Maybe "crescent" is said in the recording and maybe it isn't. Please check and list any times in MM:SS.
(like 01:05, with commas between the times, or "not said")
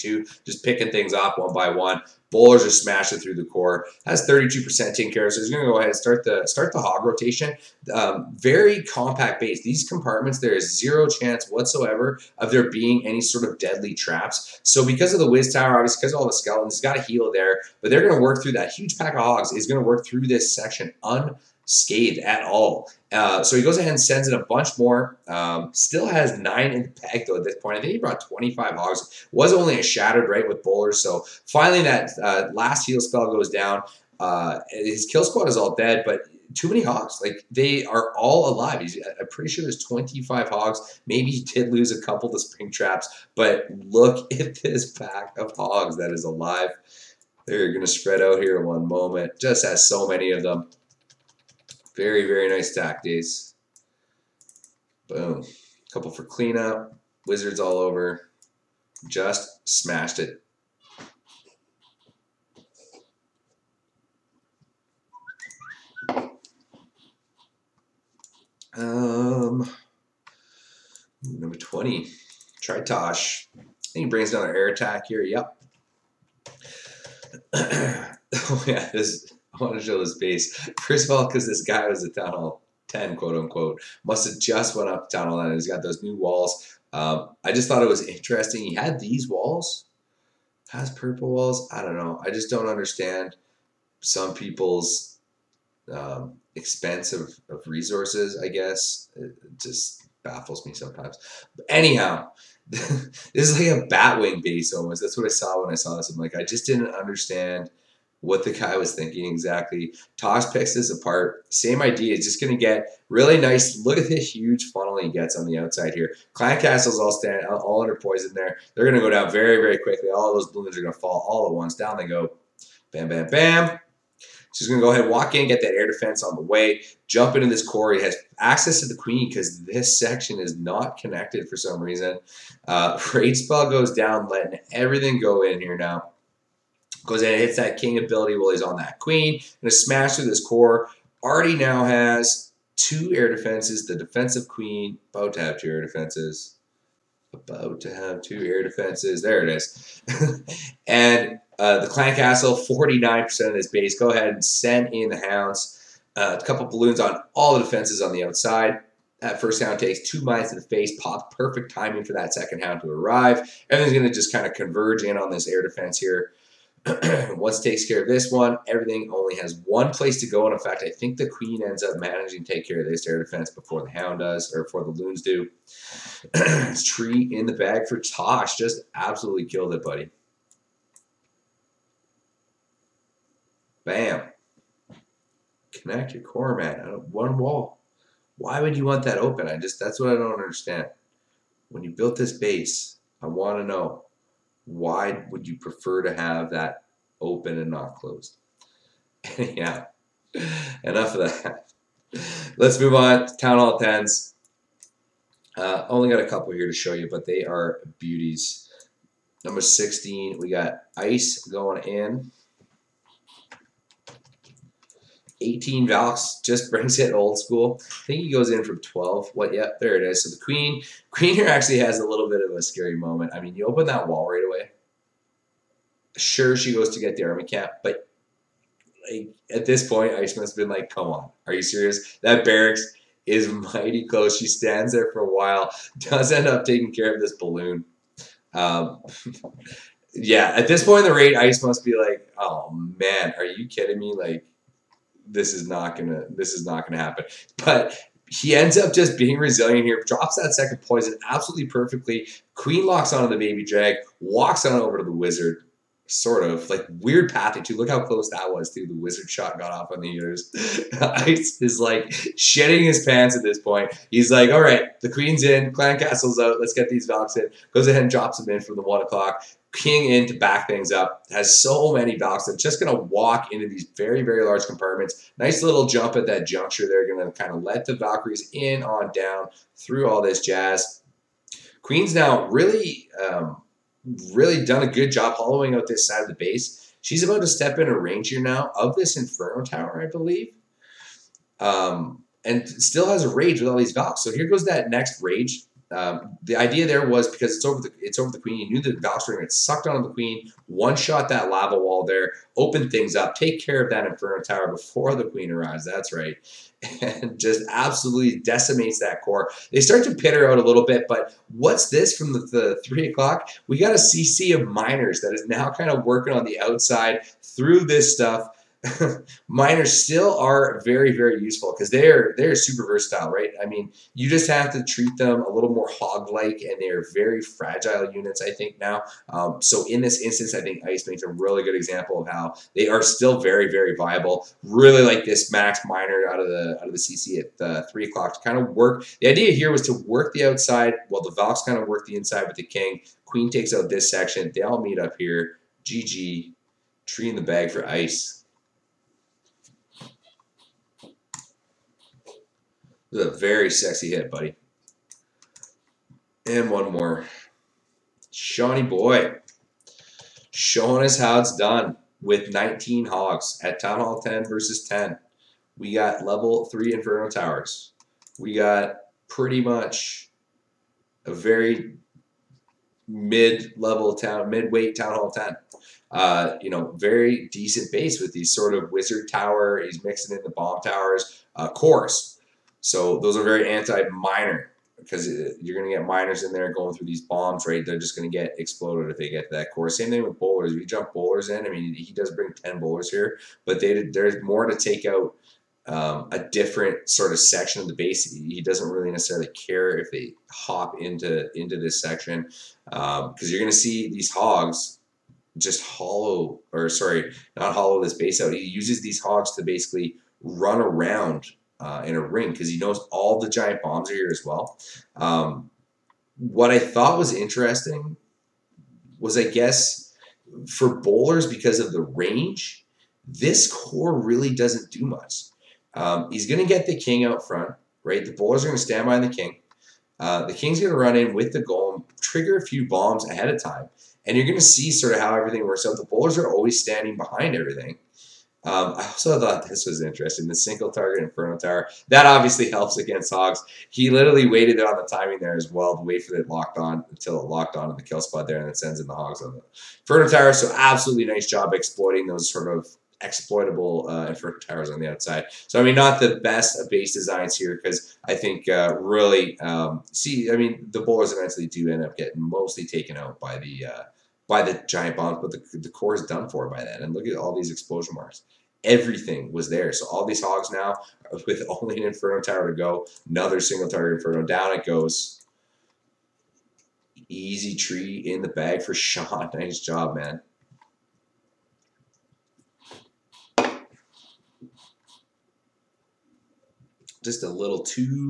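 not said.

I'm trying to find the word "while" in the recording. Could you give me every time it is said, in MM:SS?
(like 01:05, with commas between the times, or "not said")
02:18, 03:55, 05:41.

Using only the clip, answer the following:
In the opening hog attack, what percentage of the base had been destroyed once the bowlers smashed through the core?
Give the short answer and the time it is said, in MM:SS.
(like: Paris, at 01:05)
32%, at 00:04.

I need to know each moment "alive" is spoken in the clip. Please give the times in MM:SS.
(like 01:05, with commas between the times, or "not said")
00:38, 00:46.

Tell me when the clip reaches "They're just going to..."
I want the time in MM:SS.
06:27.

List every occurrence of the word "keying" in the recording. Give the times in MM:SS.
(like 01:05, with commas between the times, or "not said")
04:29.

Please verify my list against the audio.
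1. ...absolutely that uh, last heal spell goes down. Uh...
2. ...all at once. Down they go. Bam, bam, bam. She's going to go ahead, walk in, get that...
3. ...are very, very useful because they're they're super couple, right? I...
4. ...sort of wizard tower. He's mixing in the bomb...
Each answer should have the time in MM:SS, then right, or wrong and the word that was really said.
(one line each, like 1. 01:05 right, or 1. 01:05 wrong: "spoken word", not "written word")
1. 00:31 wrong: "finally", not "absolutely"
2. 02:01 right
3. 05:20 wrong: "versatile", not "couple"
4. 06:18 right.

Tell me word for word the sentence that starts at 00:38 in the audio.
He's, I'm pretty sure there's 25 hogs.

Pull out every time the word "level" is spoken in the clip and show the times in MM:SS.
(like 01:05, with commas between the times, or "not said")
06:06, 06:13.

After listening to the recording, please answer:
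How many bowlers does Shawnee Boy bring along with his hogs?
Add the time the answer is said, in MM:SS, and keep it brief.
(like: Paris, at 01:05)
10, at 06:32.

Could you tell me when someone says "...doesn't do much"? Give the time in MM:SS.
07:04.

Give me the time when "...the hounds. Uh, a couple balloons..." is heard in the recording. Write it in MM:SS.
02:35.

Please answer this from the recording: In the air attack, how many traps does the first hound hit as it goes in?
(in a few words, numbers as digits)
2.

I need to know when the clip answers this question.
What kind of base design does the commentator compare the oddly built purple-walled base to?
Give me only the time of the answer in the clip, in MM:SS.
01:43.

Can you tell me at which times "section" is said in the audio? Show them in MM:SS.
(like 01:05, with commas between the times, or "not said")
00:20, 02:09, 05:44, 06:37, 06:41.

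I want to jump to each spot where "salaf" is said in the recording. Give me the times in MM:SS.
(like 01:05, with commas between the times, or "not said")
not said.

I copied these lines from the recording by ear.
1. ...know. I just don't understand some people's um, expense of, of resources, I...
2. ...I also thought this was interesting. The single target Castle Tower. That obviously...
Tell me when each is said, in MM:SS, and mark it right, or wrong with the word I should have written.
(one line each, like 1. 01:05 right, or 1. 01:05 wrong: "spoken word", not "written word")
1. 01:31 right
2. 07:18 wrong: "Inferno", not "Castle".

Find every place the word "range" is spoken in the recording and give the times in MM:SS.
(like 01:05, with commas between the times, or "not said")
04:47, 07:02.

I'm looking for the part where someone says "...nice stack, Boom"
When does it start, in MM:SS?
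00:52.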